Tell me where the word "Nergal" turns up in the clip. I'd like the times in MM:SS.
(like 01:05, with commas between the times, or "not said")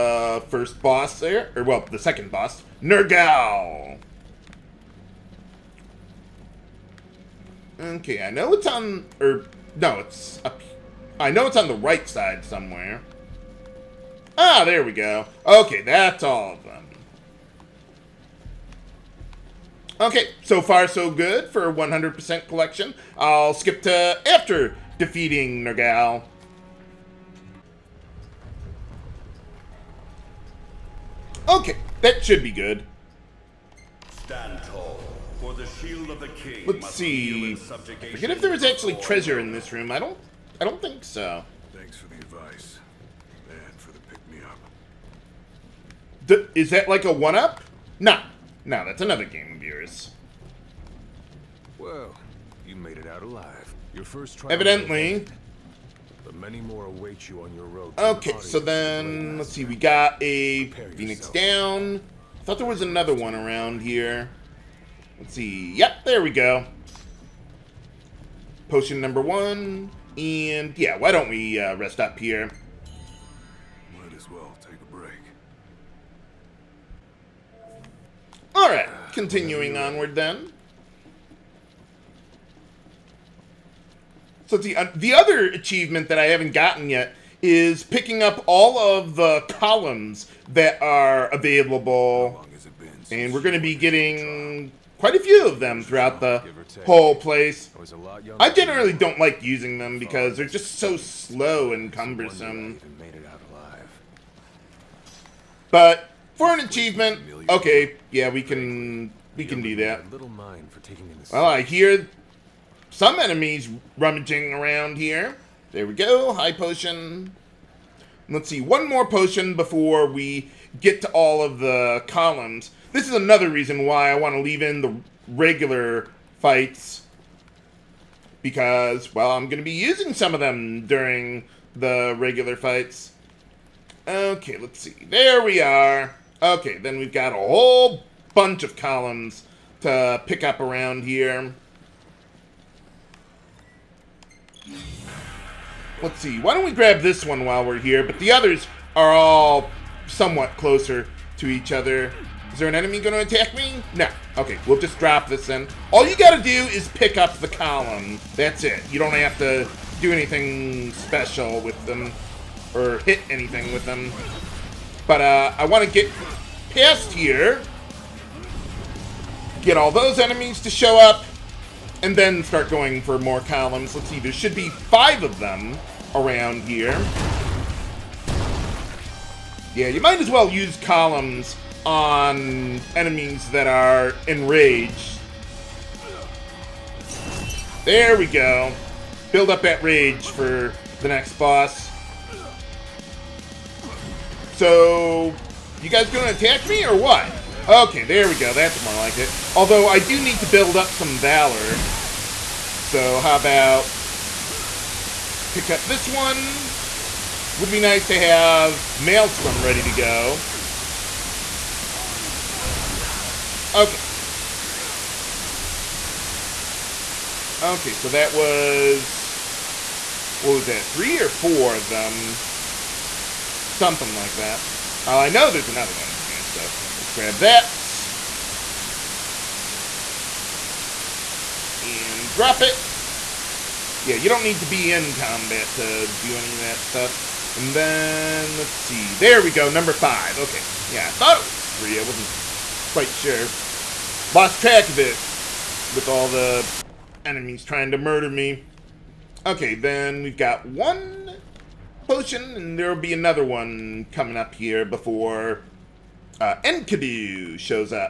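00:02, 00:25.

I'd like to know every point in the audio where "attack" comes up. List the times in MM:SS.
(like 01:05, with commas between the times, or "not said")
02:33, 03:16.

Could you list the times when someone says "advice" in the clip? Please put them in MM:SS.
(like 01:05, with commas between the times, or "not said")
00:42.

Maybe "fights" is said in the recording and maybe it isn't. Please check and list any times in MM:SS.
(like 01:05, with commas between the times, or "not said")
02:06, 02:12.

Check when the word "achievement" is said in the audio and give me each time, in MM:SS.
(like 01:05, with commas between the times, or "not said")
01:25, 01:46.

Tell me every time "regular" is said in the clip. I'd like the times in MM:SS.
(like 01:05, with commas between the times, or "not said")
02:05, 02:12.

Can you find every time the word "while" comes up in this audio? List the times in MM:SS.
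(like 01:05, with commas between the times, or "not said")
02:27.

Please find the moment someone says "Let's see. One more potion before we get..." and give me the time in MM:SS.
01:58.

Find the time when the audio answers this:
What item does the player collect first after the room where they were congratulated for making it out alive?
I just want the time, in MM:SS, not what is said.
01:00.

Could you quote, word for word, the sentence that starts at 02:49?
Get all those enemies to show up and then start going for more columns.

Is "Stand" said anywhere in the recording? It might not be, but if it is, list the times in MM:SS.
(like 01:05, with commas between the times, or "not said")
00:34.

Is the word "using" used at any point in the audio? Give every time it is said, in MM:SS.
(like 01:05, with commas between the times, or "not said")
01:39, 02:09.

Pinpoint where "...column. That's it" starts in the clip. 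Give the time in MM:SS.
02:37.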